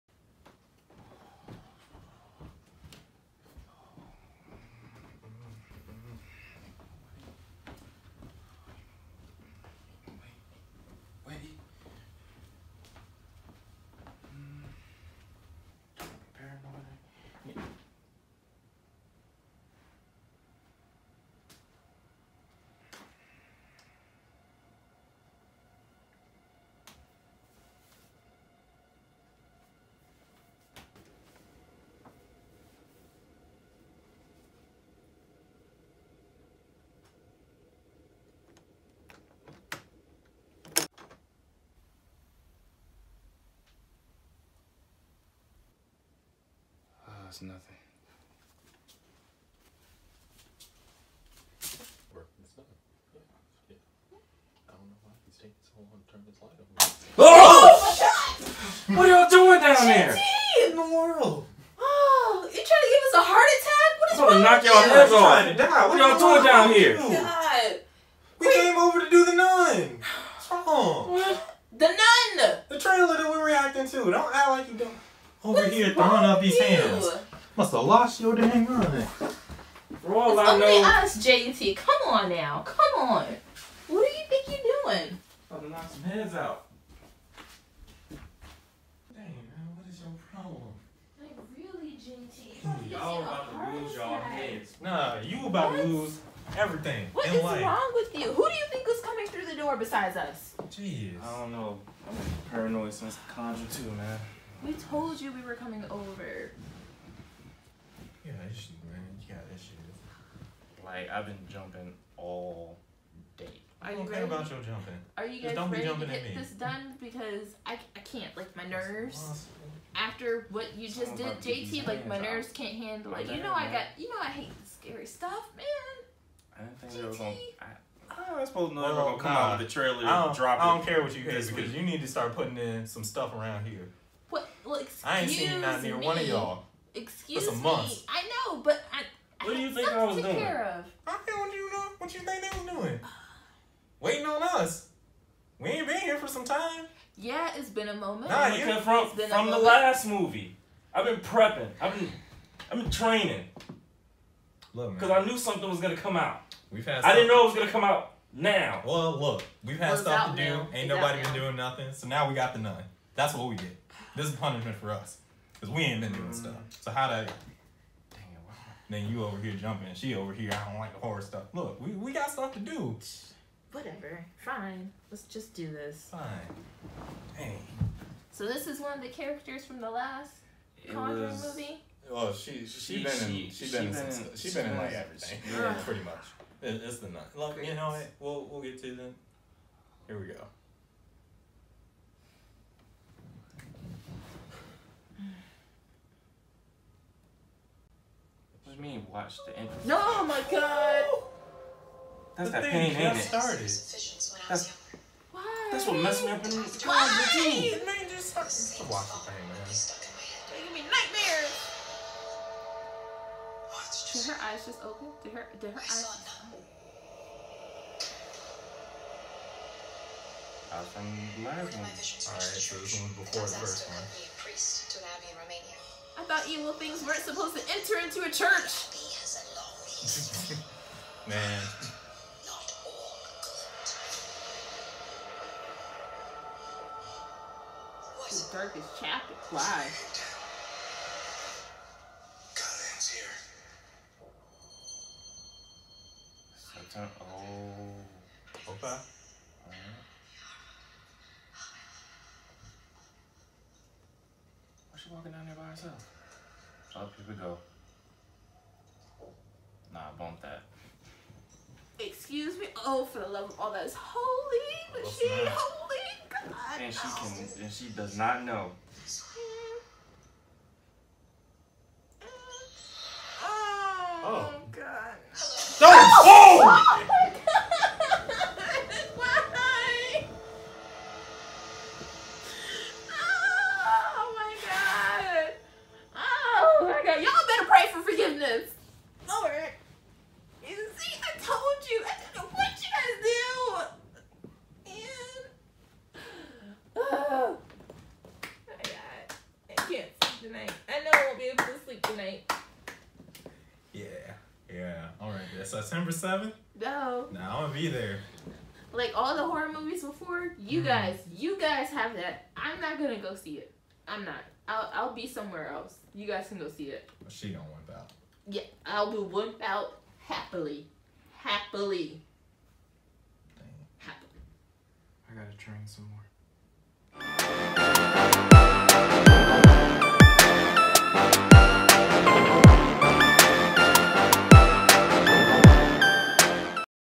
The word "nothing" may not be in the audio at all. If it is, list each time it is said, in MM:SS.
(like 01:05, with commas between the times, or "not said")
00:47, 02:41.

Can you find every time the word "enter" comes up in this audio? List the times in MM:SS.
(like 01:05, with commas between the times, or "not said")
03:47.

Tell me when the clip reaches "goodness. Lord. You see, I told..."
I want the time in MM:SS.
04:48.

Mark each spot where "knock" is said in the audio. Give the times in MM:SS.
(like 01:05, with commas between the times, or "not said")
01:04, 01:25.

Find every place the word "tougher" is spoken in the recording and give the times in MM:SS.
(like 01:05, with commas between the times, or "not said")
not said.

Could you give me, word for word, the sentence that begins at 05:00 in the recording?
I know I won't be able to sleep tonight.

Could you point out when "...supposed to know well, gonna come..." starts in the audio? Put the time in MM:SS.
02:08.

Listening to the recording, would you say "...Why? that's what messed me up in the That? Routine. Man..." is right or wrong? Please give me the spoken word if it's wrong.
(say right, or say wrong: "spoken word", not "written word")
wrong: "Why", not "That".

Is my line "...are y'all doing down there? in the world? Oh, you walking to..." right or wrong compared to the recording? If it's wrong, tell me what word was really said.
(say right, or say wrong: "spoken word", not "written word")
wrong: "trying", not "walking".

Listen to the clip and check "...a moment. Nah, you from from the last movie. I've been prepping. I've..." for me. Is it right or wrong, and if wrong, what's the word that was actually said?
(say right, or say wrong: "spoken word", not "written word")
right.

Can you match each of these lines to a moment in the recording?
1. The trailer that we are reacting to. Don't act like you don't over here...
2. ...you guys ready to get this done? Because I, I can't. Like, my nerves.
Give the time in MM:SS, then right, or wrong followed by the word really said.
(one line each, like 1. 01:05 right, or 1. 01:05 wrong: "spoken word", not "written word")
1. 01:12 right
2. 01:55 right.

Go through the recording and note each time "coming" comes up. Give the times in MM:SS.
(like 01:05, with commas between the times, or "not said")
01:39, 01:45.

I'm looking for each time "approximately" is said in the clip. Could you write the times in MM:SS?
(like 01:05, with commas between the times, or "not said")
not said.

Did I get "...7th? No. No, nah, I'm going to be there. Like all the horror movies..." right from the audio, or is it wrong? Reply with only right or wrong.
right.